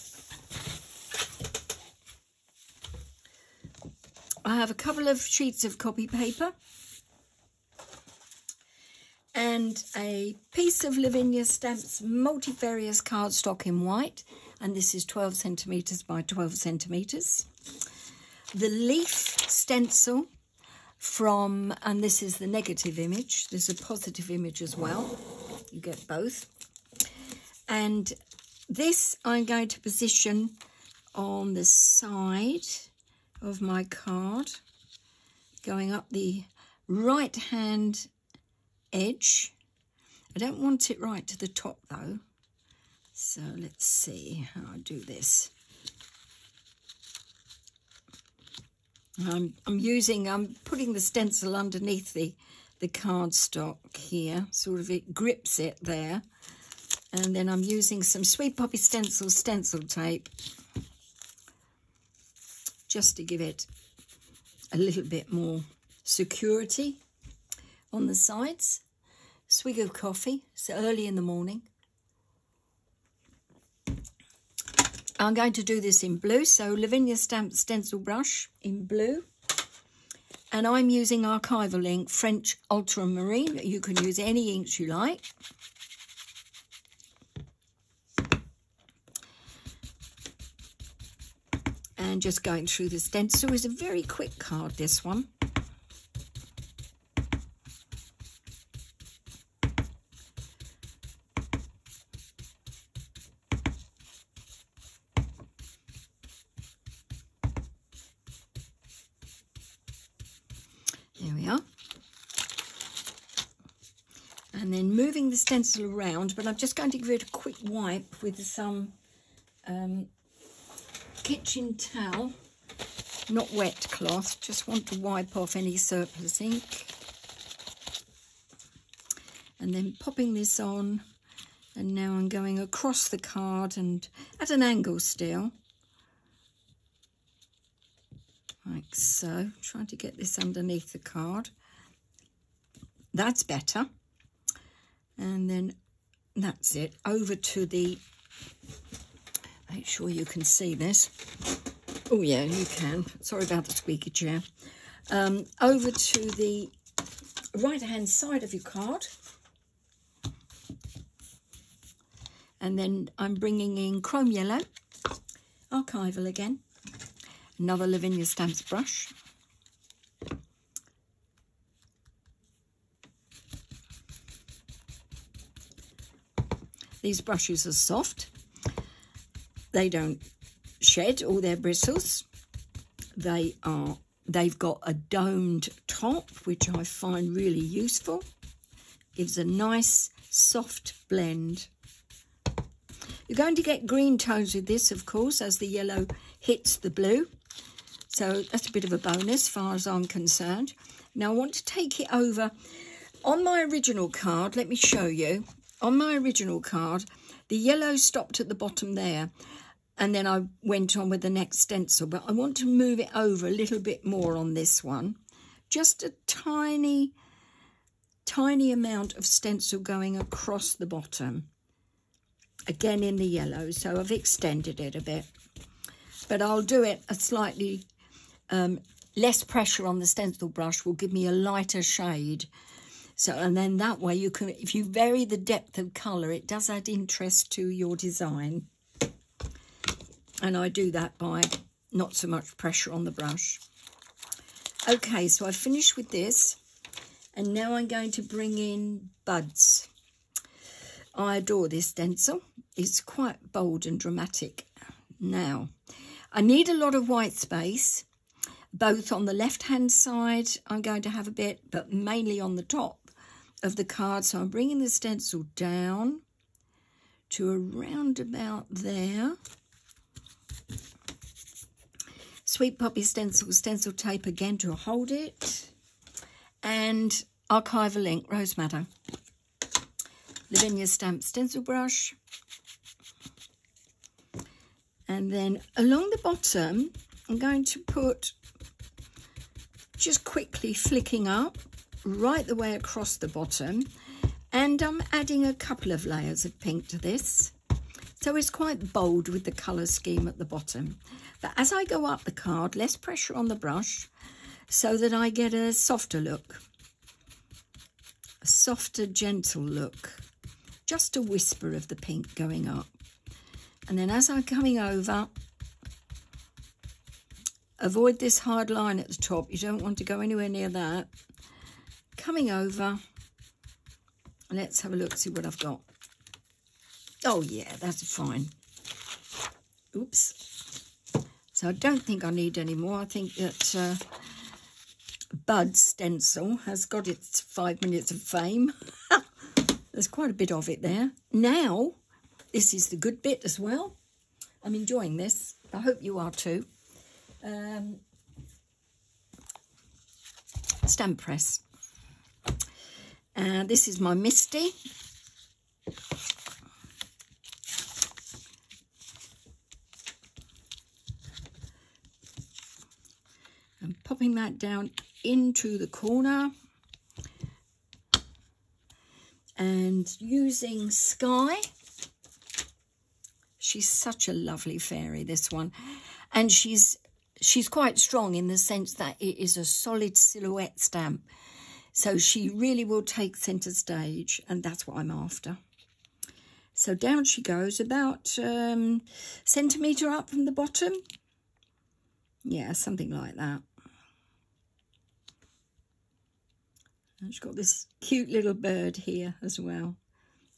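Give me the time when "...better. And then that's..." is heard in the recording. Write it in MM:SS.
02:23.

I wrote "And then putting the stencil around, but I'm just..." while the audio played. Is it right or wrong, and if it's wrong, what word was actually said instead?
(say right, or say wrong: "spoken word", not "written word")
wrong: "moving", not "putting".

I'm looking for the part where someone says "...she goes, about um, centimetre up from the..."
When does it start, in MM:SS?
06:27.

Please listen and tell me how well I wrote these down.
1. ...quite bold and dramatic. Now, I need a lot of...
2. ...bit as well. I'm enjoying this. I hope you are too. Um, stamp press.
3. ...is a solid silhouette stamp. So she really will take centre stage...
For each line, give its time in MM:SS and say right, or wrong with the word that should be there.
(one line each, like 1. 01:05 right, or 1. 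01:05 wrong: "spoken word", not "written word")
1. 04:13 right
2. 05:43 right
3. 06:19 right.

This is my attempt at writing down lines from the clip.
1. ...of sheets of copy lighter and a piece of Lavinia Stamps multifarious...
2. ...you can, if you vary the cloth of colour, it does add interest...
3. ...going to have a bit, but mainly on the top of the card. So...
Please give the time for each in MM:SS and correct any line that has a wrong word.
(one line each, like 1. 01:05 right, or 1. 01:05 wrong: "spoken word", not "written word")
1. 00:05 wrong: "paper", not "lighter"
2. 03:54 wrong: "depth", not "cloth"
3. 04:20 right.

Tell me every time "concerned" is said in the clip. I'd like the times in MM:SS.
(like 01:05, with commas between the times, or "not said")
03:20.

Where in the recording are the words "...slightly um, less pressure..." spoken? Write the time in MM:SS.
03:47.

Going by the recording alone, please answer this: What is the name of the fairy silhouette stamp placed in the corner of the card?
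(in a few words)
Sky.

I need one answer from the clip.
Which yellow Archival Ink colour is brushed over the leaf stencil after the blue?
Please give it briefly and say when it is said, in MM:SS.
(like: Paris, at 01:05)
Chrome Yellow, at 02:44.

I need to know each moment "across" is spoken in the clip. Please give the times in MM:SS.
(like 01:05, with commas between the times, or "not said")
02:12, 03:40, 04:52.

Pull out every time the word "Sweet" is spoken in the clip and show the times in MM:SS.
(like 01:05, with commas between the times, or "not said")
00:58, 04:32.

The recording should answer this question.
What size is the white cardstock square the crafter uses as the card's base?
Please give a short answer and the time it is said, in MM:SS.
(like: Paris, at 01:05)
12 cm by 12 cm, at 00:15.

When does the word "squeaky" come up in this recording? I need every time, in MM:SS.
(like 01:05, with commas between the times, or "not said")
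02:33.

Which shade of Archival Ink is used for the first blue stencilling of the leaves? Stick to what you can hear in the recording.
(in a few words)
French Ultramarine.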